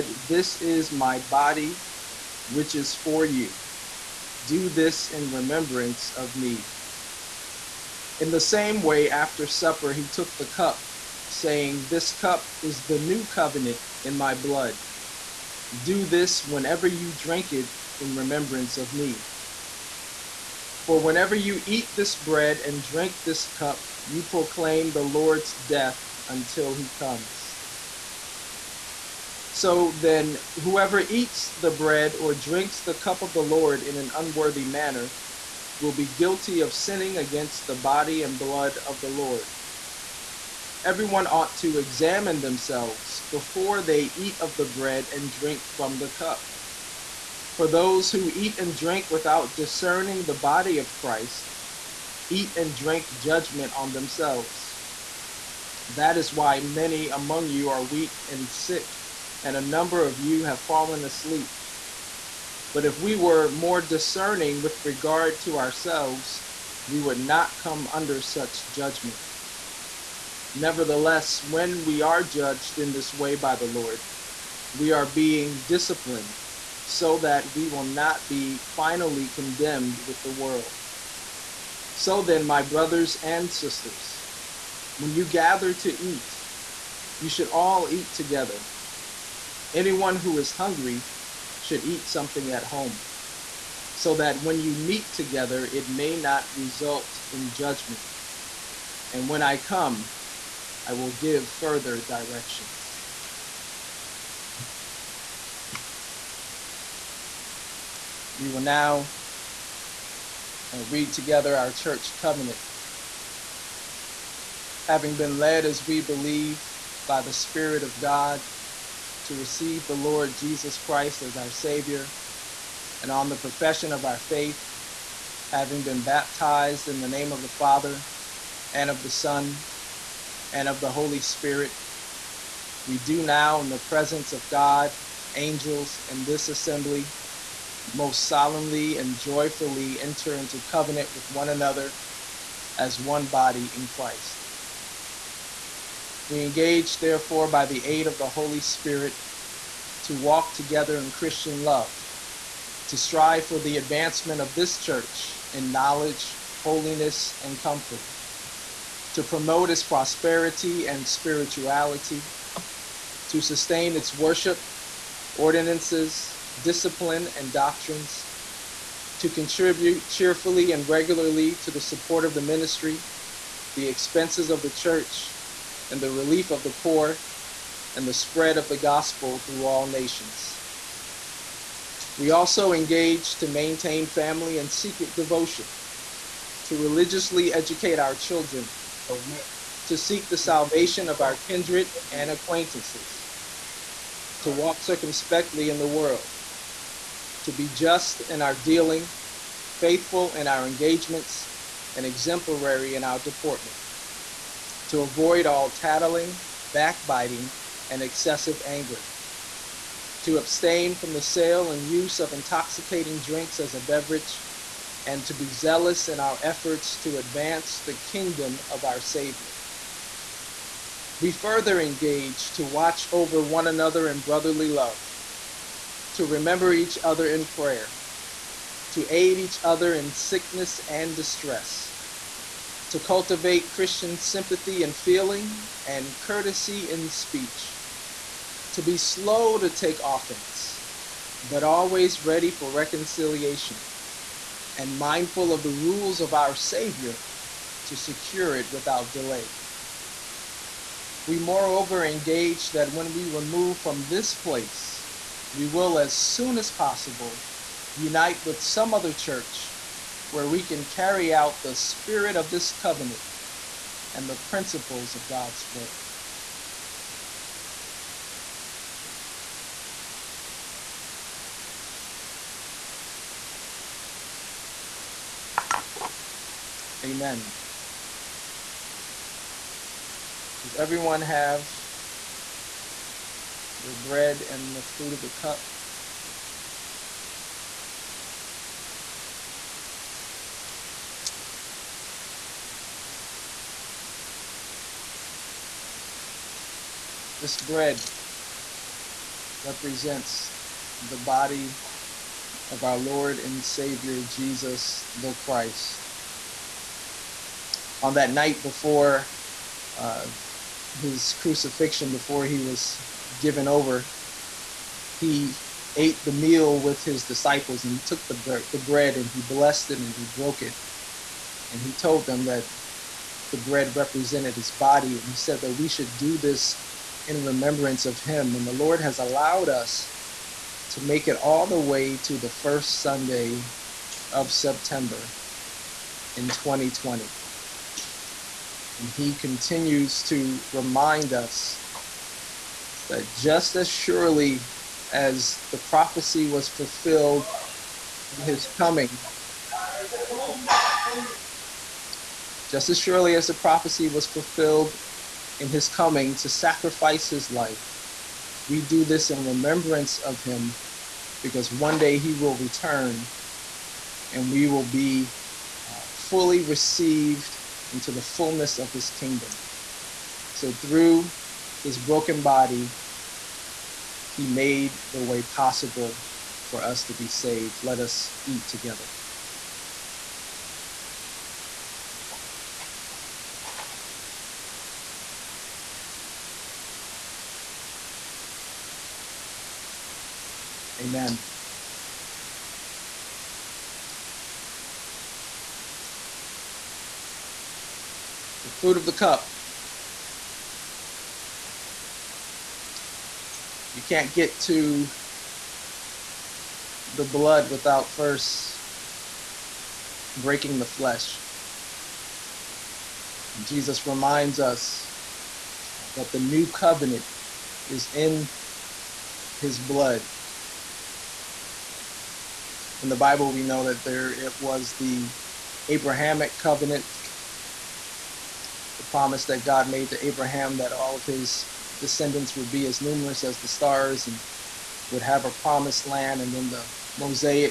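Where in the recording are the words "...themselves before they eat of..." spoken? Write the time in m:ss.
0:42.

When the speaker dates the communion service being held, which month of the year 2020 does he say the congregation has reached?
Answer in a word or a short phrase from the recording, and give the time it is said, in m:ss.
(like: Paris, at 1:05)
September, at 5:32.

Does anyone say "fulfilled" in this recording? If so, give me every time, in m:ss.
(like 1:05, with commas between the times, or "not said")
5:46, 5:54.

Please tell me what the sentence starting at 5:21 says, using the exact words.
And he told them that the bread represented his body.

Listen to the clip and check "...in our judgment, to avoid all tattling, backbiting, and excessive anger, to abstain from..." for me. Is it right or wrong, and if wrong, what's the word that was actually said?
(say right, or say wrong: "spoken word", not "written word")
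wrong: "deportment", not "judgment".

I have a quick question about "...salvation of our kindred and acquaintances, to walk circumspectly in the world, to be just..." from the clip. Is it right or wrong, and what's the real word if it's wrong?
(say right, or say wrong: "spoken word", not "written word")
right.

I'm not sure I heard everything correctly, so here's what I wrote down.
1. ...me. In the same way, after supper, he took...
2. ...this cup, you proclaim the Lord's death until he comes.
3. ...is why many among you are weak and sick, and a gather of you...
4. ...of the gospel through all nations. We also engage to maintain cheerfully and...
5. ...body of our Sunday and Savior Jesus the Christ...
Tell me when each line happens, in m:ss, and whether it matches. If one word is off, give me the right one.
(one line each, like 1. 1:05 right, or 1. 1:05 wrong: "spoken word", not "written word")
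1. 0:06 right
2. 0:23 right
3. 0:56 wrong: "number", not "gather"
4. 2:58 wrong: "family", not "cheerfully"
5. 5:01 wrong: "Lord", not "Sunday".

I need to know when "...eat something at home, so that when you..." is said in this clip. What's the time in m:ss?
1:31.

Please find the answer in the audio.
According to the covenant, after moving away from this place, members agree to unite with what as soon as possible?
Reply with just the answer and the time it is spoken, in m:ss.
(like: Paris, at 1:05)
some other church, at 4:18.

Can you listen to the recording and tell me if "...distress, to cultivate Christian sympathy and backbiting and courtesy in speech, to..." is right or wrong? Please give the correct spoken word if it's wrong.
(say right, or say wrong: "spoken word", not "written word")
wrong: "feeling", not "backbiting".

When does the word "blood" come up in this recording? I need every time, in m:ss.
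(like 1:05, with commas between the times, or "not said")
0:14, 0:38, 6:47, 6:59.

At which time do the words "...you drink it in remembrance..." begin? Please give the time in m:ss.
0:16.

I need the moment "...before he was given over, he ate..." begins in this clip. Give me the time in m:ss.
5:12.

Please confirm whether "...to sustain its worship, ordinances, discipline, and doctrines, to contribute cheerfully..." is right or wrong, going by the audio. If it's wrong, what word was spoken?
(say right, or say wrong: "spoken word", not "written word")
right.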